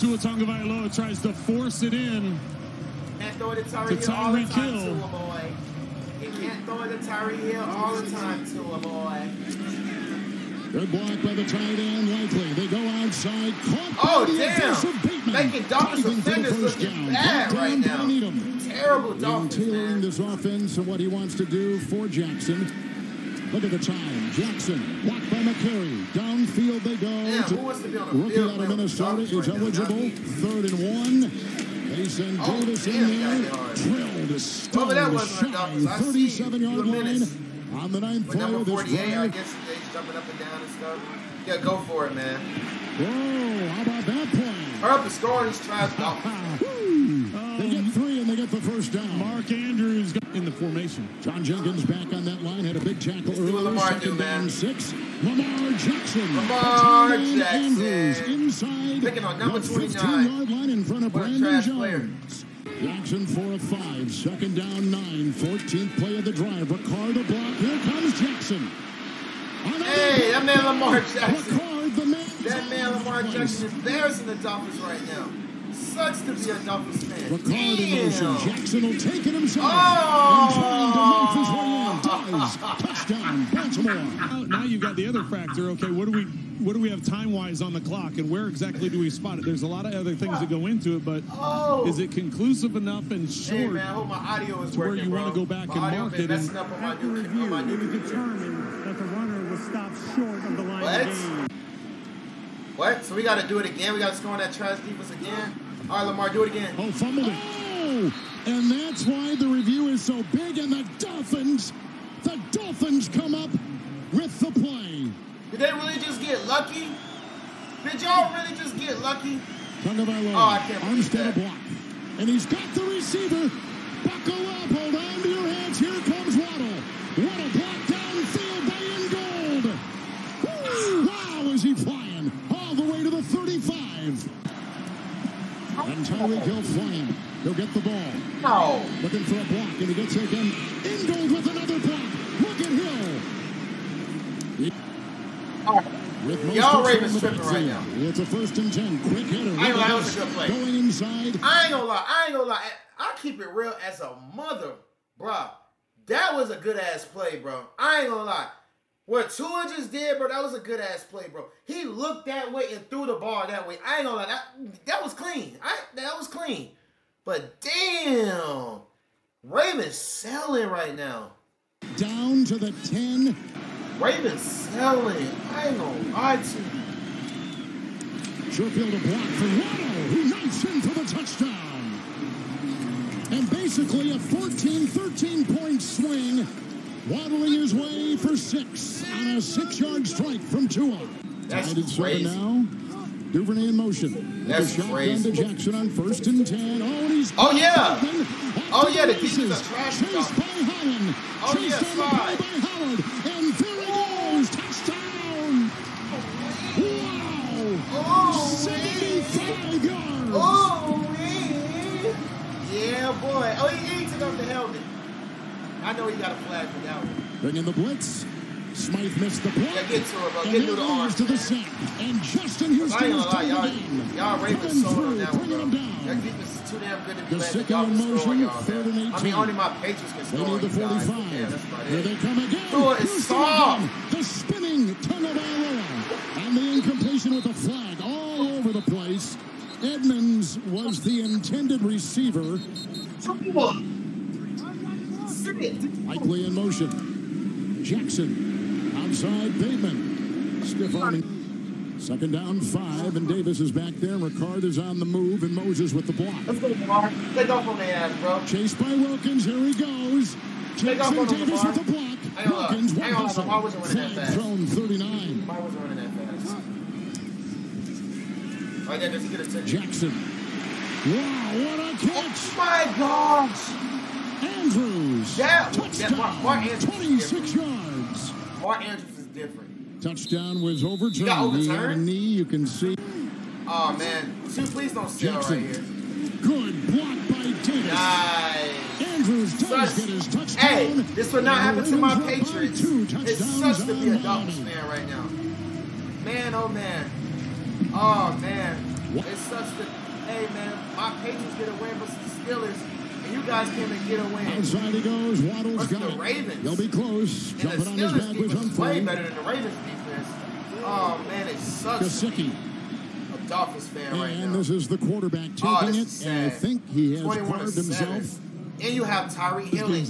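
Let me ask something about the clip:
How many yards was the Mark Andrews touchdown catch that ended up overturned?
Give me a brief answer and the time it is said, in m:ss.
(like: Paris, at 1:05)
26, at 4:37.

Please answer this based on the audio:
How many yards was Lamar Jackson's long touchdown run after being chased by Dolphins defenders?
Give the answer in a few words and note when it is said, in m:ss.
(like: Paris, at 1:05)
75, at 3:28.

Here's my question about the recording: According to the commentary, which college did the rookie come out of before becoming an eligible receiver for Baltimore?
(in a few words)
Minnesota.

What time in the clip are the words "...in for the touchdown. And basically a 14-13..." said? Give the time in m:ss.
3:00.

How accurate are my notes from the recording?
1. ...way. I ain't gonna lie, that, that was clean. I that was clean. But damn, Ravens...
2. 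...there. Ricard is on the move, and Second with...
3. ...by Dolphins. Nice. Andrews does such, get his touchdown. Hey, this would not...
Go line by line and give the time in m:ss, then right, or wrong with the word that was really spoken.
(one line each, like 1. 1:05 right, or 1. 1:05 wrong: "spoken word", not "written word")
1. 2:43 right
2. 4:13 wrong: "Moses", not "Second"
3. 4:47 wrong: "Davis", not "Dolphins".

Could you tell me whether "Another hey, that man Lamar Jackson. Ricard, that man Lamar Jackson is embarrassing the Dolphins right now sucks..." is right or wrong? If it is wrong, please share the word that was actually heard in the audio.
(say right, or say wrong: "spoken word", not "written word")
right.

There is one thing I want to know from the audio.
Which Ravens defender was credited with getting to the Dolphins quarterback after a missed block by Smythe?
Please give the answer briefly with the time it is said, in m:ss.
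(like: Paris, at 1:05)
Justin Houston, at 3:42.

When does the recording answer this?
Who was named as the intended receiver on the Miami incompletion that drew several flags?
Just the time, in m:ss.
3:59.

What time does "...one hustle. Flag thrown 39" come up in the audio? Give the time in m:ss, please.
4:22.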